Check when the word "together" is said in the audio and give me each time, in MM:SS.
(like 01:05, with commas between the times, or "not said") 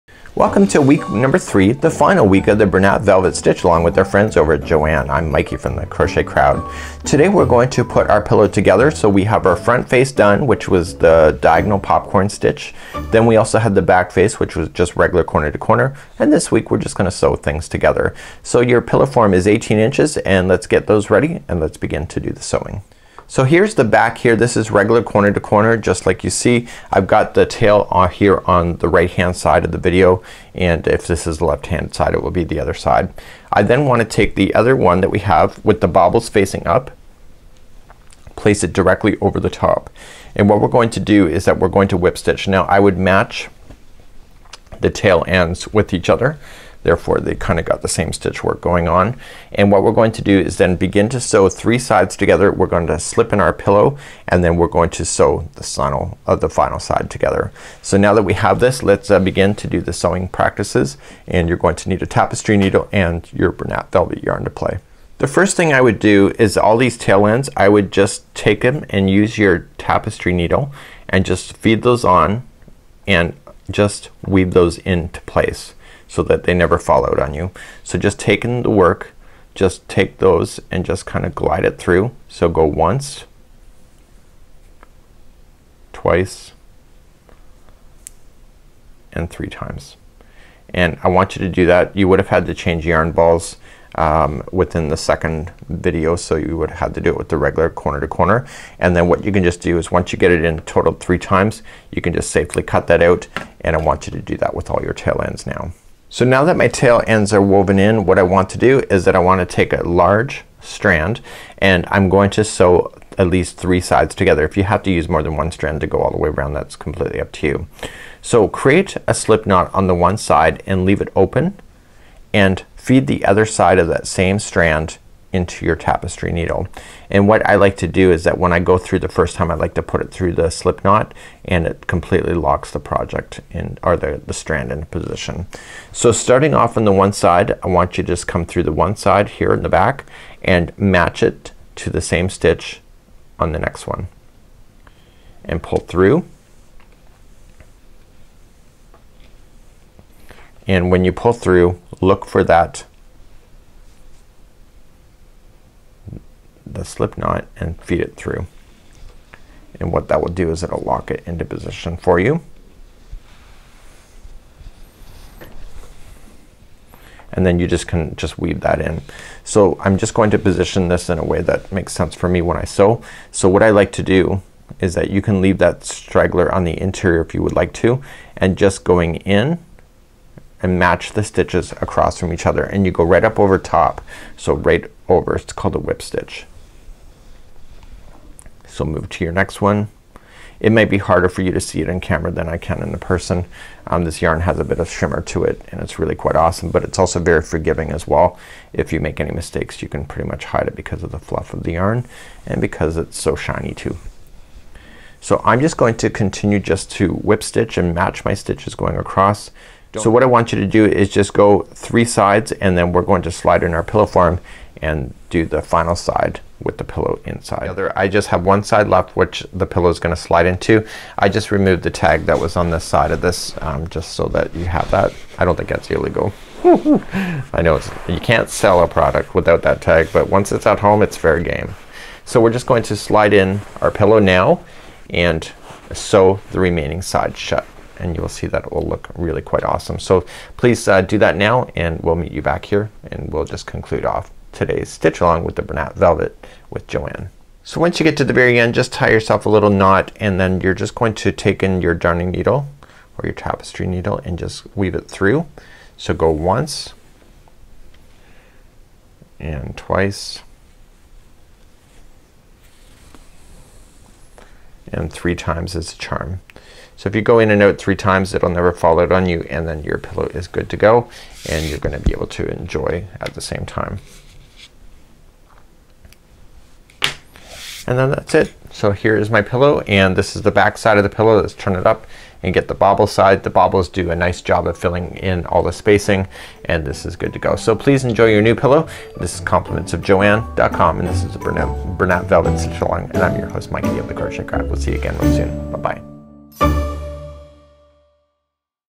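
00:08, 00:17, 00:52, 00:57, 01:54.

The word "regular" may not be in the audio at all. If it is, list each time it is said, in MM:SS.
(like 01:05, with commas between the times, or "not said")
00:14, 00:24, 01:37.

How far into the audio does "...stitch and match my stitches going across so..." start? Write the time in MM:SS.
03:27.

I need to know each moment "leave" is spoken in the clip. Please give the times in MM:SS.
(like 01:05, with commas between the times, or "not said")
02:00, 02:55.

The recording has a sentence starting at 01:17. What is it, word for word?
So just taking the work, just take those and just kind of glide it through.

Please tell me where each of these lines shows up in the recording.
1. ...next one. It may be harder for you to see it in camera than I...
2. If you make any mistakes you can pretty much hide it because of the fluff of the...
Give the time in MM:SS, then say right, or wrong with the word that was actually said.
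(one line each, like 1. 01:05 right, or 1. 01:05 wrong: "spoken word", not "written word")
1. 03:09 right
2. 03:18 right.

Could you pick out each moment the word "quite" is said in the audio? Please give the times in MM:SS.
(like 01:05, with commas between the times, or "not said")
03:16, 03:59.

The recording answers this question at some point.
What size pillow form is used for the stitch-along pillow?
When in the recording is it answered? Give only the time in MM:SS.
00:19.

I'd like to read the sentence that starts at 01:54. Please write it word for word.
If you have to use more than one strand to go all the way around that's completely up to you.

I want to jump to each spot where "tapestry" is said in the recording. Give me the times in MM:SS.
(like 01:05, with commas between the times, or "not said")
01:02, 01:09, 02:05, 04:13.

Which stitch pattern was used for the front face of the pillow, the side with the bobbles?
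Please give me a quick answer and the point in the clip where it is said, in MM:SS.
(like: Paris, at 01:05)
diagonal popcorn stitch, at 00:11.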